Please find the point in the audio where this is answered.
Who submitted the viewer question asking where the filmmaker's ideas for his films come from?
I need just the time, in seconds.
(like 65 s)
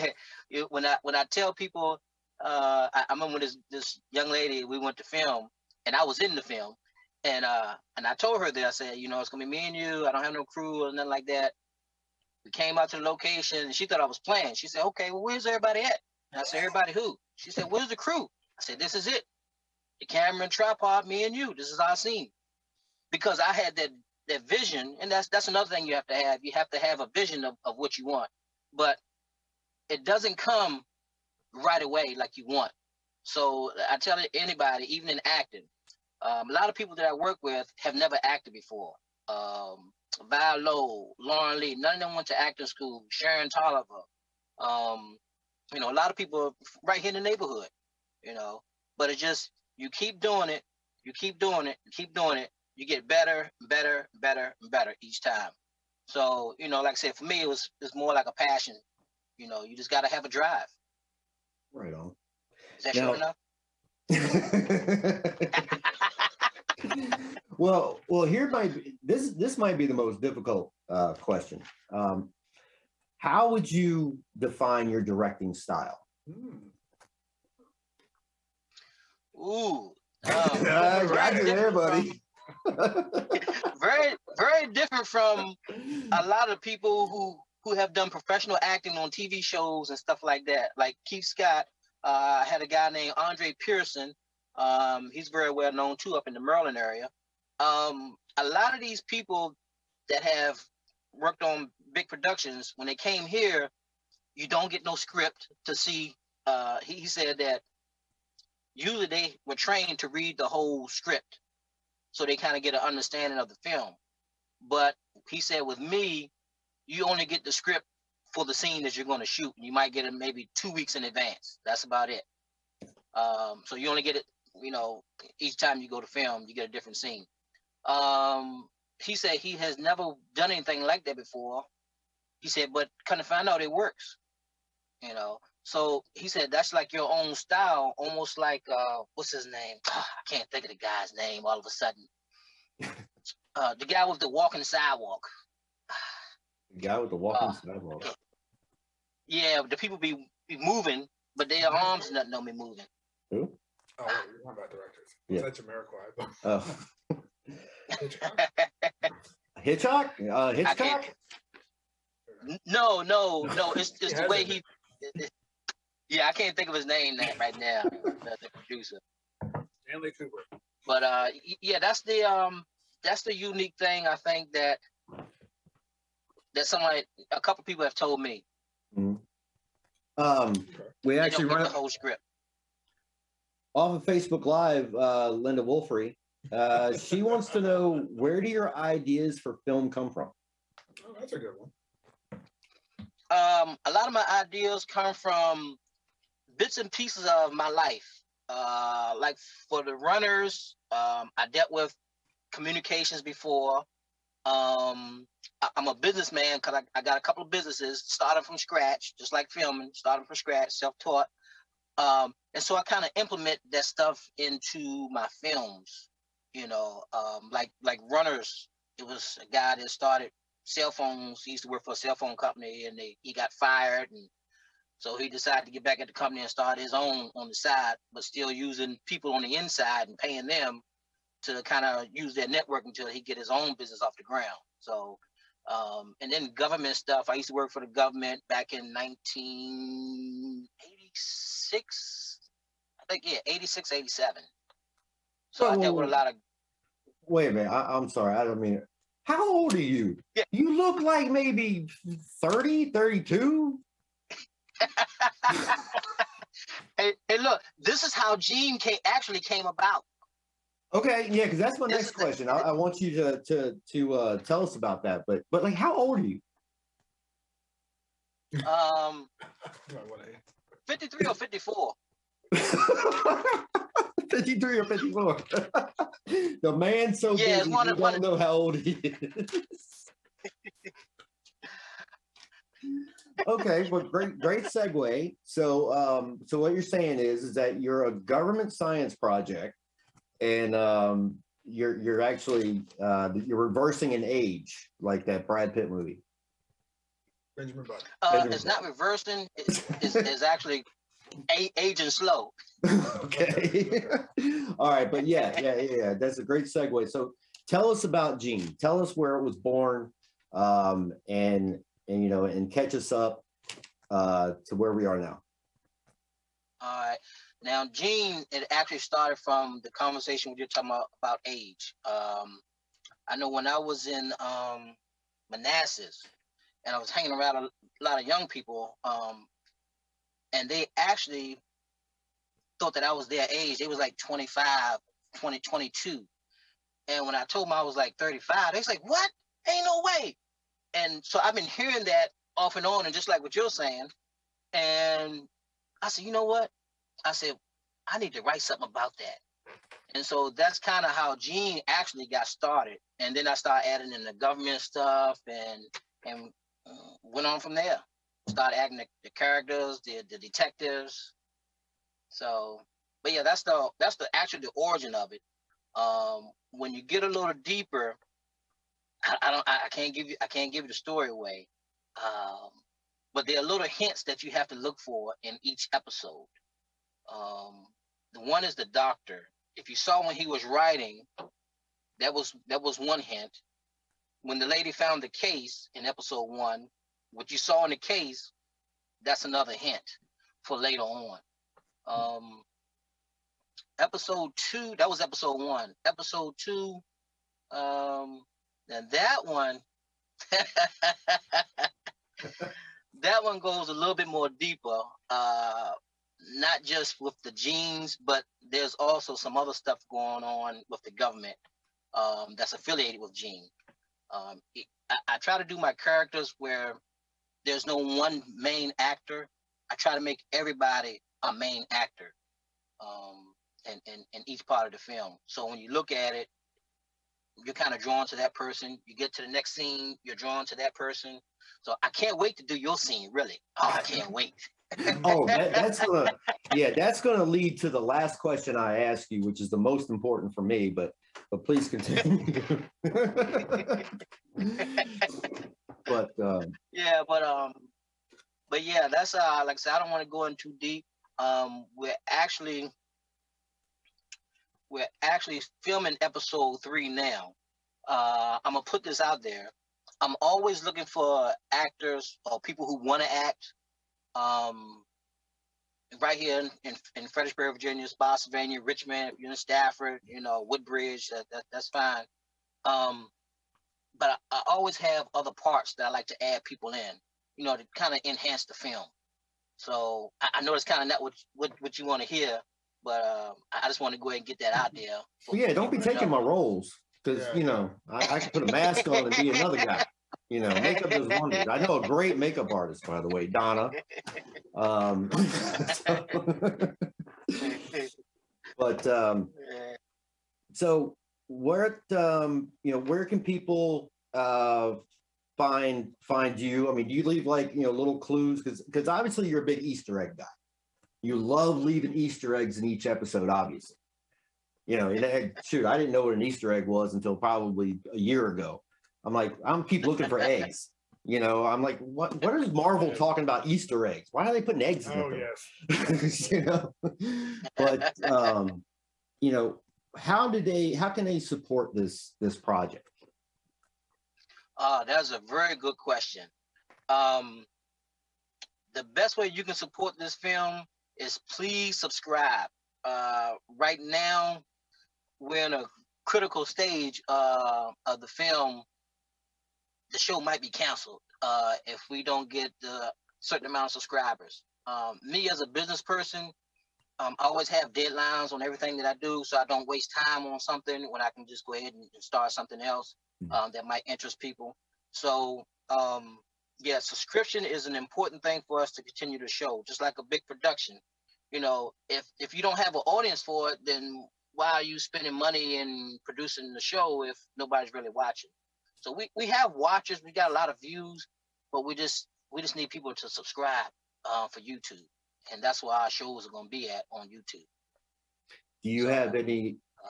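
185 s.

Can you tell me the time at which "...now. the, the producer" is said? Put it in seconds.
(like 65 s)
167 s.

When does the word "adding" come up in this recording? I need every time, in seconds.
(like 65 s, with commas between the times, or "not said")
353 s, 358 s.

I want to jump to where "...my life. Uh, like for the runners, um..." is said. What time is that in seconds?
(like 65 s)
197 s.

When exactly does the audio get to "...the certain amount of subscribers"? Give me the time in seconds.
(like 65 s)
552 s.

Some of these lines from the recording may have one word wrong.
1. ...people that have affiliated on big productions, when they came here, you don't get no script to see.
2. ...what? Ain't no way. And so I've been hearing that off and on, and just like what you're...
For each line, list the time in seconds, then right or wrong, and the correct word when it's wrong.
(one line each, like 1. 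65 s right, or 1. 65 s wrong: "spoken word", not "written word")
1. 99 s wrong: "worked", not "affiliated"
2. 339 s right.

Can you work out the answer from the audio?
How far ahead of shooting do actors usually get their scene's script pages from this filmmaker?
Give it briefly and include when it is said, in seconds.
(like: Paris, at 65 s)
2 weeks, at 120 s.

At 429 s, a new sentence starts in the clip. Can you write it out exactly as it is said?
You get to the next scene, you're drawn to that person.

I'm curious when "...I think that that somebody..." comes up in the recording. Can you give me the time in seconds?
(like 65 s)
174 s.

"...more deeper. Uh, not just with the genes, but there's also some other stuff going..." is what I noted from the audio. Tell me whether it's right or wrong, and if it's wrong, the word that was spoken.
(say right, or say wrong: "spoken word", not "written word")
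right.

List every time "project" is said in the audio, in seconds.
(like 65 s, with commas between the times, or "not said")
289 s, 532 s.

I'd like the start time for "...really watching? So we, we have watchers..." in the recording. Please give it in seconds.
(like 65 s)
577 s.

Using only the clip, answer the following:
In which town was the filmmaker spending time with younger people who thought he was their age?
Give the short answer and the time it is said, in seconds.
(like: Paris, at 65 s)
Manassas, at 325 s.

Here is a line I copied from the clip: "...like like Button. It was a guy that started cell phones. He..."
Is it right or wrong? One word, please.
wrong.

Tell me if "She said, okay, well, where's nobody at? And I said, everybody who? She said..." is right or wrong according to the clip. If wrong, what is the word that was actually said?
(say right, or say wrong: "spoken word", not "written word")
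wrong: "everybody", not "nobody".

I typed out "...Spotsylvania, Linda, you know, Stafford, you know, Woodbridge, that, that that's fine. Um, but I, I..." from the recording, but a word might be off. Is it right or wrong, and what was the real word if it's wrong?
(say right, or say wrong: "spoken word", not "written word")
wrong: "Richmond", not "Linda".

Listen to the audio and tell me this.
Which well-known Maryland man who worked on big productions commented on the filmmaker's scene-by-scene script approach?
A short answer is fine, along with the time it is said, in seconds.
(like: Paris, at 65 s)
Andre Pearson, at 93 s.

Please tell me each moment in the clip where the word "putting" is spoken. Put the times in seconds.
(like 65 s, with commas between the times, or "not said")
524 s.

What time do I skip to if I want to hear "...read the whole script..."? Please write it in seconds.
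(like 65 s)
110 s.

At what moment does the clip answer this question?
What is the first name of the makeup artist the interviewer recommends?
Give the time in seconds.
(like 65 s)
493 s.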